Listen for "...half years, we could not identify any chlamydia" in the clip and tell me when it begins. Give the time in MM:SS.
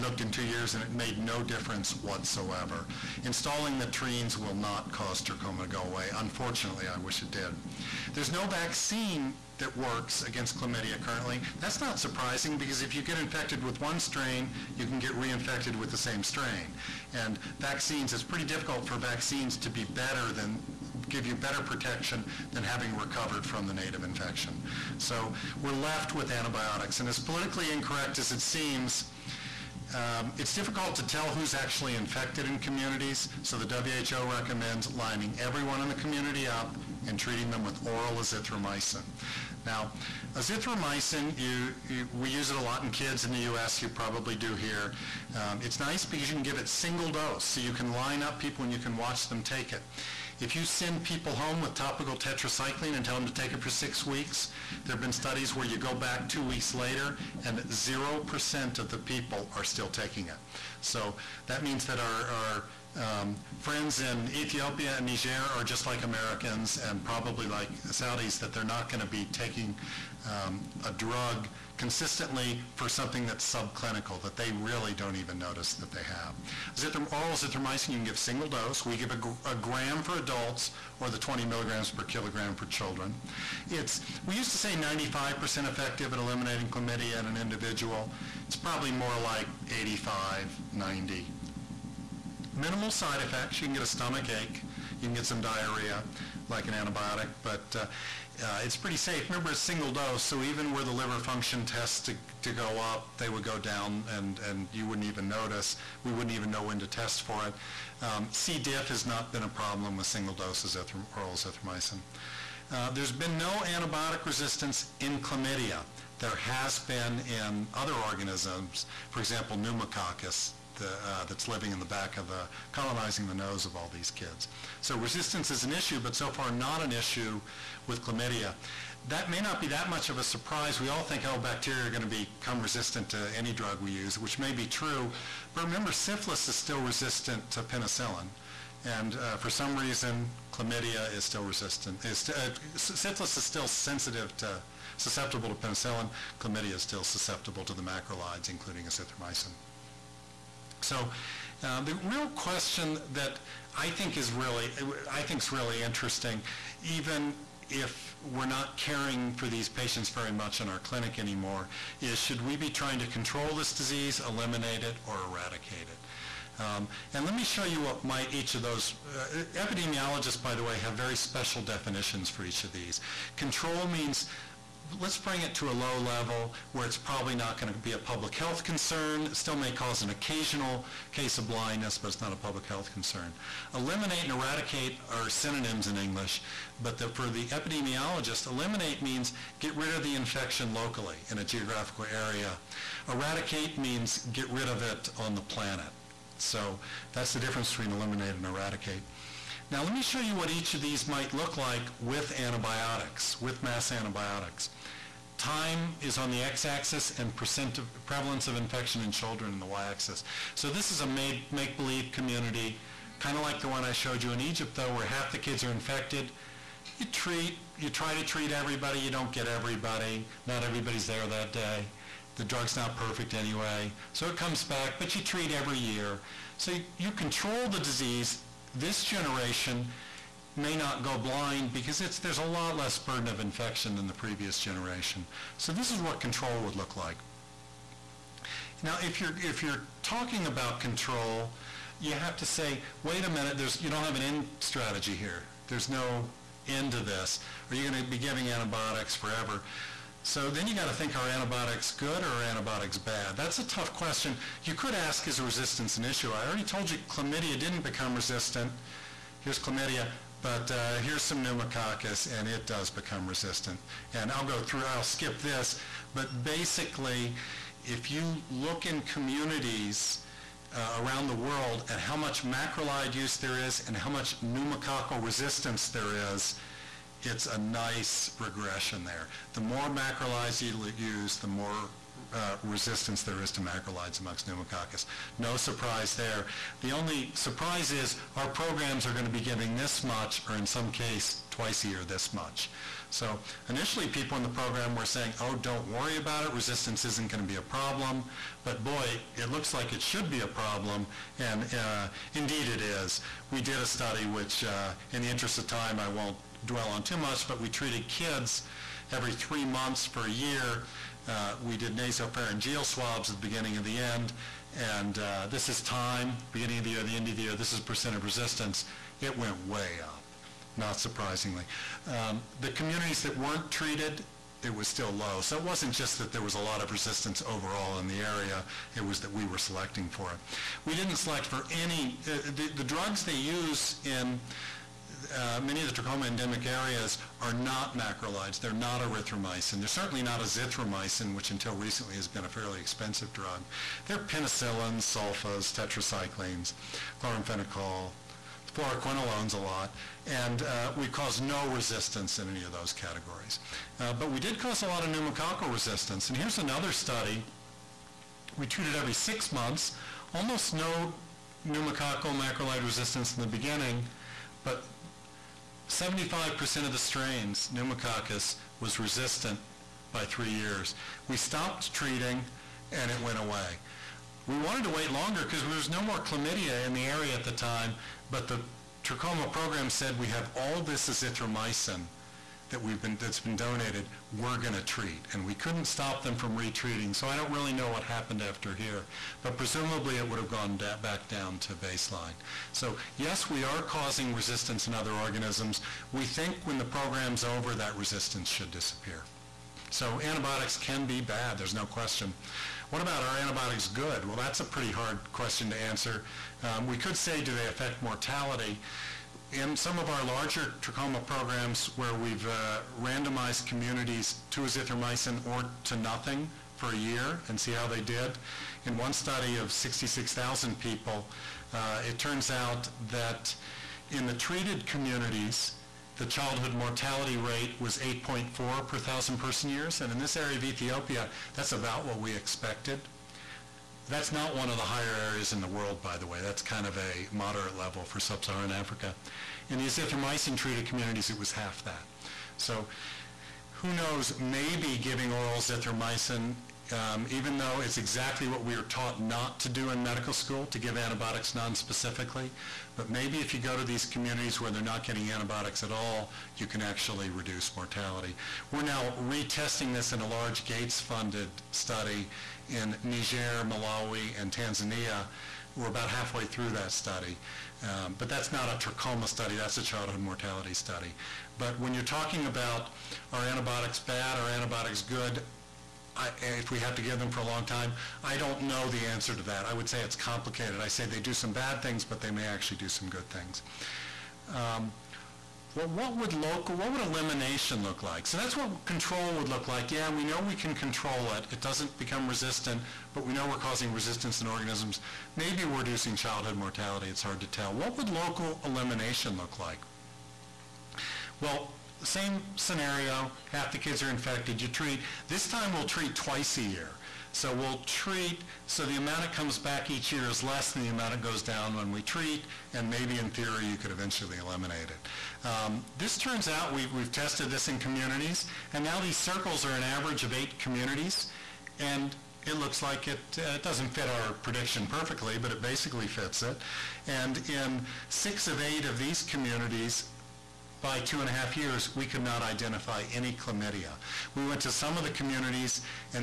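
08:51.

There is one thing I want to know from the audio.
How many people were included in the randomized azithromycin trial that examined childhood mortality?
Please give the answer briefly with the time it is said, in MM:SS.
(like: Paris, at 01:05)
66,000, at 06:59.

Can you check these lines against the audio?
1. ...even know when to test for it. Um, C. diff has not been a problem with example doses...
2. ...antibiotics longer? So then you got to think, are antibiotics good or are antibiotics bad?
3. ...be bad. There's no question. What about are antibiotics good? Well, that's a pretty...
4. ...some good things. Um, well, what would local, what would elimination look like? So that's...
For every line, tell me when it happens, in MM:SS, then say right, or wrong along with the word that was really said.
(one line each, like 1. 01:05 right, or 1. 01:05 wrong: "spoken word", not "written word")
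1. 01:46 wrong: "single", not "example"
2. 04:08 wrong: "forever", not "longer"
3. 06:41 right
4. 08:02 right.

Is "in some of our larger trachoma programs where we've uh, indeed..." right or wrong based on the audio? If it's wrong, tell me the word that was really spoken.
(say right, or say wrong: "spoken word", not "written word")
wrong: "randomized", not "indeed".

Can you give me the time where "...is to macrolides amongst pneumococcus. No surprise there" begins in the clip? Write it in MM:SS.
04:43.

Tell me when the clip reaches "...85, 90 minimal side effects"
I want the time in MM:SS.
01:29.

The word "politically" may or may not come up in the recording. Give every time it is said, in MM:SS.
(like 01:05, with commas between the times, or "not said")
00:27.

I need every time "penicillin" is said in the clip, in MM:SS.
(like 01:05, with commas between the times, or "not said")
02:17, 02:25, 05:44.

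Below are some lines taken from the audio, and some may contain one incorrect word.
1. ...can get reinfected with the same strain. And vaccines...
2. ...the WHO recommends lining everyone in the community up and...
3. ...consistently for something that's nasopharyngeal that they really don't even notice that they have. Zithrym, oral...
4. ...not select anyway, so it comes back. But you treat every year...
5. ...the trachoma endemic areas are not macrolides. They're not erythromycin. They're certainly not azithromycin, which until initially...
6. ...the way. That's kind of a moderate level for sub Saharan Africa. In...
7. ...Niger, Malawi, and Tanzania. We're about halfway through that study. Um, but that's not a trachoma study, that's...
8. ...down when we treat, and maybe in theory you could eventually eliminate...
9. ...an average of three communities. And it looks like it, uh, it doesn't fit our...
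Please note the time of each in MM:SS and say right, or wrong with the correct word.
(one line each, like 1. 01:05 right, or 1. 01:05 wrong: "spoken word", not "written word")
1. 00:14 right
2. 00:33 right
3. 01:11 wrong: "subclinical", not "nasopharyngeal"
4. 03:42 wrong: "perfect", not "select"
5. 05:35 wrong: "recently", not "initially"
6. 07:16 right
7. 07:43 right
8. 08:31 right
9. 08:39 wrong: "eight", not "three".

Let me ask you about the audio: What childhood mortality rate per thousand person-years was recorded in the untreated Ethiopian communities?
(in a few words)
8.4.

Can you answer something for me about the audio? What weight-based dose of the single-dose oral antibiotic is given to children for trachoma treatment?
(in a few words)
20 milligrams per kilogram.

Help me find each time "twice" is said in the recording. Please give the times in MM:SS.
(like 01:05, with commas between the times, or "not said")
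04:51, 08:26.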